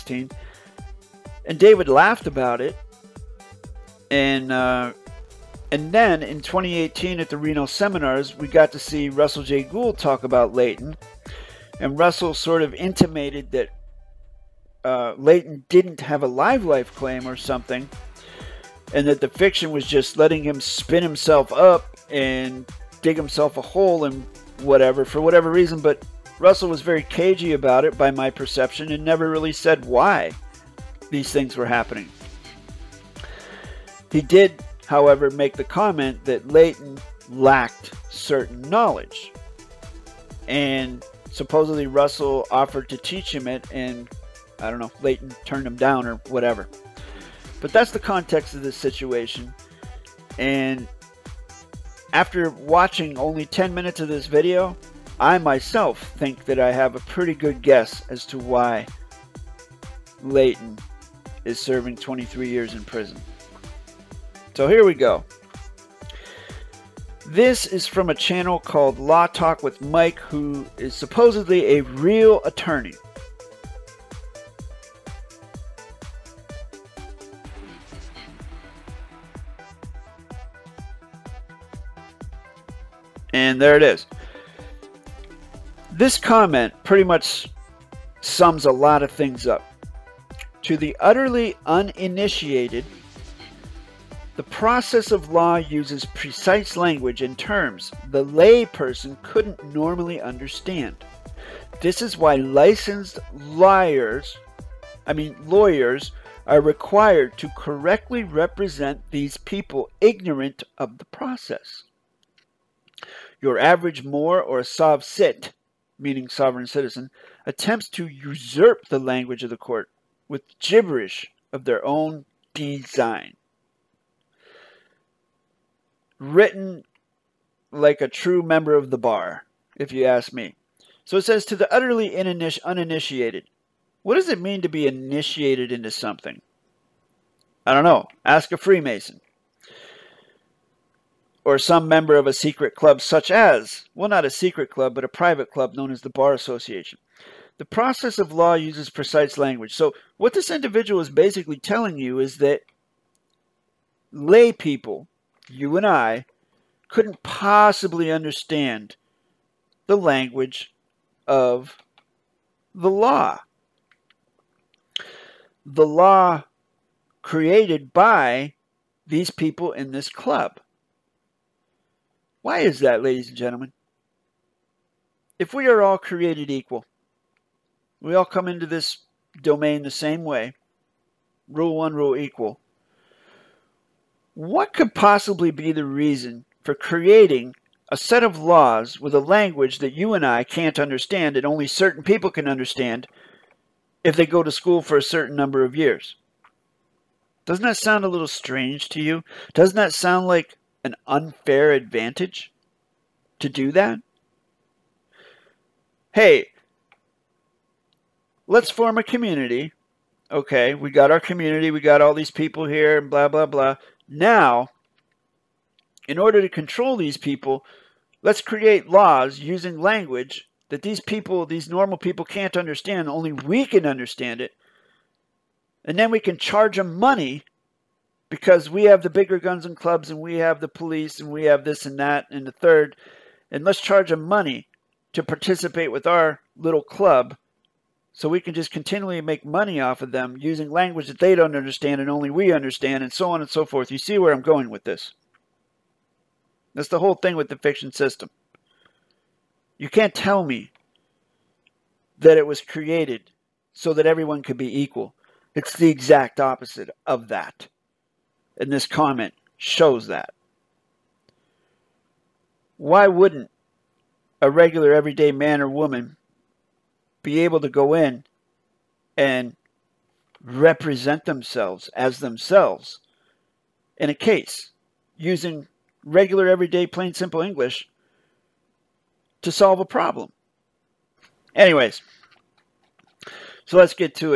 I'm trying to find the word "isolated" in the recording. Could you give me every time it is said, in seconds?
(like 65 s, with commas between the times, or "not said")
not said.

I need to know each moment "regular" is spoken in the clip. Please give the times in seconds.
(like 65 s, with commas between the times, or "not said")
264 s, 276 s.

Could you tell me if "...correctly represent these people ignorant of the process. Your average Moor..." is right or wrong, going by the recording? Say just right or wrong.
right.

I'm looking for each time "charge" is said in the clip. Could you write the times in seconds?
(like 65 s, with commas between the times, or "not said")
226 s, 233 s.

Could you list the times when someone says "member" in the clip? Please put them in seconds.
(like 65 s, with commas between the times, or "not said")
128 s, 141 s.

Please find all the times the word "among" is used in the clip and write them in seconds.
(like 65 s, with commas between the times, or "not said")
not said.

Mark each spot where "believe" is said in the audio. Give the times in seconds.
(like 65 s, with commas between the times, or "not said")
not said.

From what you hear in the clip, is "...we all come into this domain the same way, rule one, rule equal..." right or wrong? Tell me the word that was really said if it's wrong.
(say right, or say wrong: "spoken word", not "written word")
right.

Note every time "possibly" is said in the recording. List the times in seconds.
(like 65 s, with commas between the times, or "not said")
157 s, 184 s.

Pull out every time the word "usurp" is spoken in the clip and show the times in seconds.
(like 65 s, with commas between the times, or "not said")
118 s.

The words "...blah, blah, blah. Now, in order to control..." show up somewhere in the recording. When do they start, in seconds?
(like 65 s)
213 s.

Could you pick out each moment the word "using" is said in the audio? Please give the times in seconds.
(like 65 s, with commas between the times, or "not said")
219 s, 240 s, 275 s.